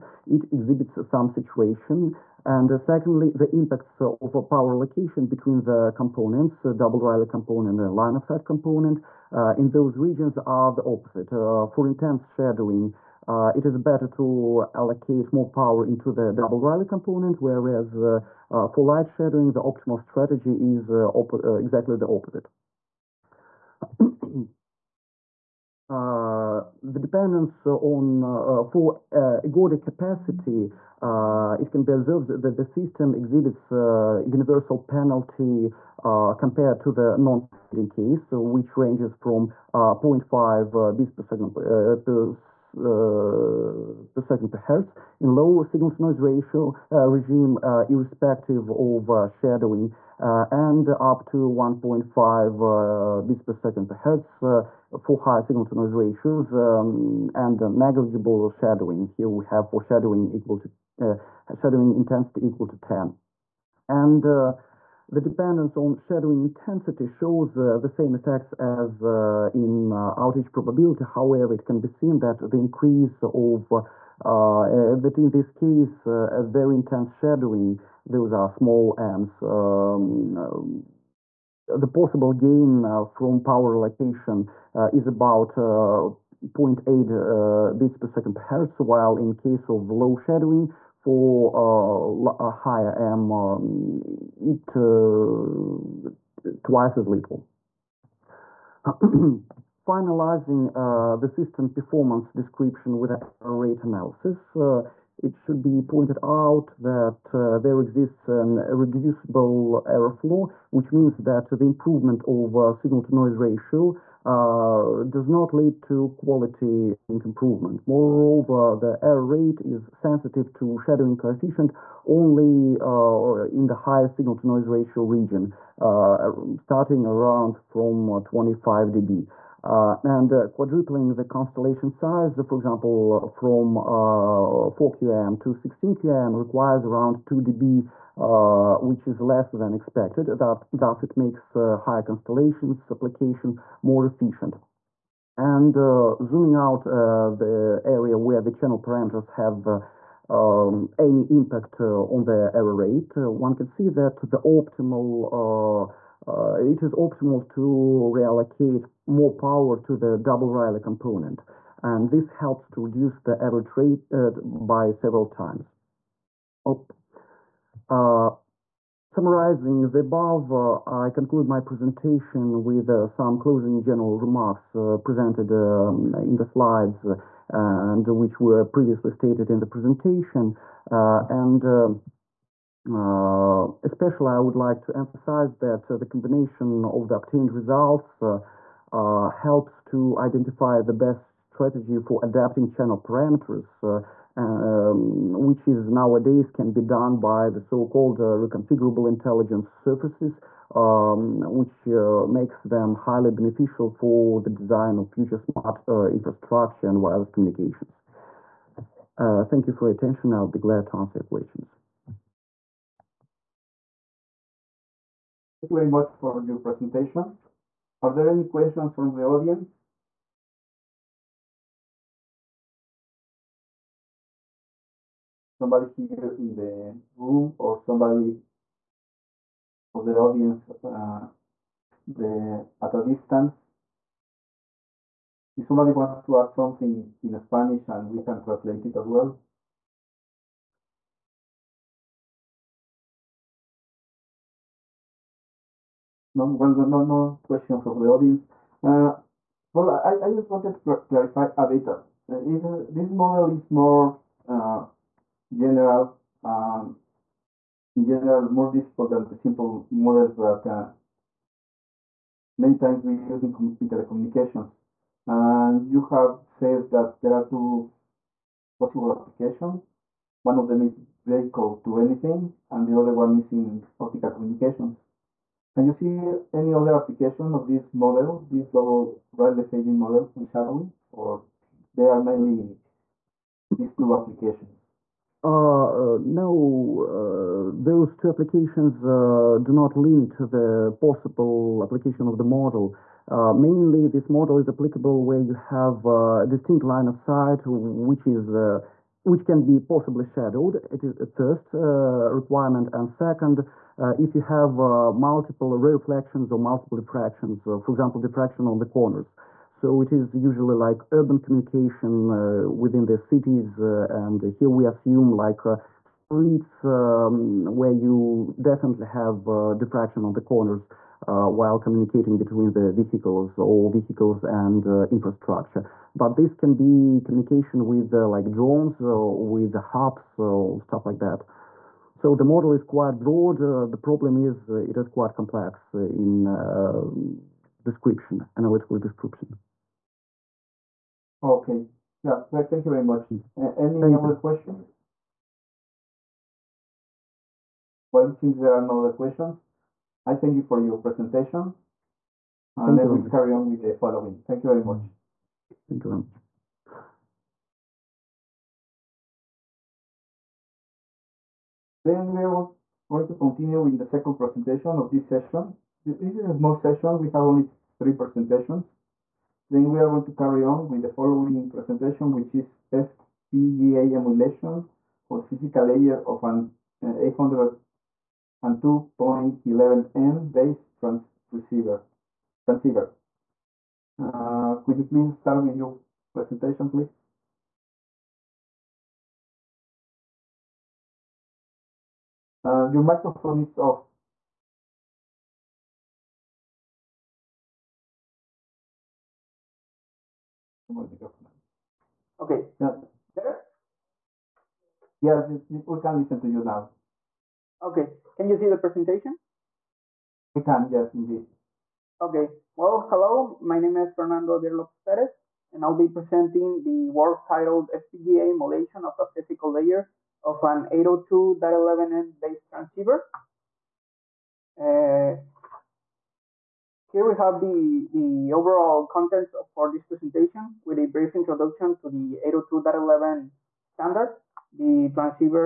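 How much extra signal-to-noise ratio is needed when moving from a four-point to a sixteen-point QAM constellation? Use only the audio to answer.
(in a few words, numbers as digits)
2 dB.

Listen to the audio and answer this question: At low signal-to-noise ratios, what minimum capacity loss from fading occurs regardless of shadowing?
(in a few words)
0.5 bits per second per hertz.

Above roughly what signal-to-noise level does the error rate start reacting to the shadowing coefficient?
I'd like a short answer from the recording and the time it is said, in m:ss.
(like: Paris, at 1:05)
25 dB, at 2:08.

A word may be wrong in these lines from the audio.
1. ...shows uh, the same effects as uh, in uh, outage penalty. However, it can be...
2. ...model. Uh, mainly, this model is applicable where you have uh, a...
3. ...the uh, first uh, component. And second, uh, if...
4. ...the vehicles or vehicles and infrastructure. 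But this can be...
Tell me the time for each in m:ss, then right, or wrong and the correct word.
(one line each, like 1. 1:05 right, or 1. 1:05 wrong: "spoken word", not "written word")
1. 1:07 wrong: "probability", not "penalty"
2. 4:52 right
3. 5:01 wrong: "requirement", not "component"
4. 5:22 right.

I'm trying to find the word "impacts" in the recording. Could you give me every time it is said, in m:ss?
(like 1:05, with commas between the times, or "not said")
0:03, 2:31.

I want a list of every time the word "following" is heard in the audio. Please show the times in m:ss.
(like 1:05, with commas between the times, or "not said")
5:53, 6:11.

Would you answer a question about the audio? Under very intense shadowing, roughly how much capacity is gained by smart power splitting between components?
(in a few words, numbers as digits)
0.8 bits per second per hertz.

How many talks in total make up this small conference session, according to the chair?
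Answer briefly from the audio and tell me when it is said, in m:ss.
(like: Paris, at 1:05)
3, at 6:07.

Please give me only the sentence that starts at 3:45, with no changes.
Somebody here in the room or somebody of the audience uh, the, at a distance?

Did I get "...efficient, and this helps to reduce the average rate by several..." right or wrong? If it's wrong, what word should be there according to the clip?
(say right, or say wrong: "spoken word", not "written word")
wrong: "component", not "efficient".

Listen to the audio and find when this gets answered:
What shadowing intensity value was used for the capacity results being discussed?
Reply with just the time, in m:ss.
1:02.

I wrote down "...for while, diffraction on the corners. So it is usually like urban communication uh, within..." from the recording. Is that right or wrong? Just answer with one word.
wrong.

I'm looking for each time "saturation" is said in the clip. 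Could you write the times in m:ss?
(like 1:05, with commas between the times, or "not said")
0:01.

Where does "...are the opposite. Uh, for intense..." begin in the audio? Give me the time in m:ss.
0:10.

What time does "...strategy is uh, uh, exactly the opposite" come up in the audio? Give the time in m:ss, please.
0:19.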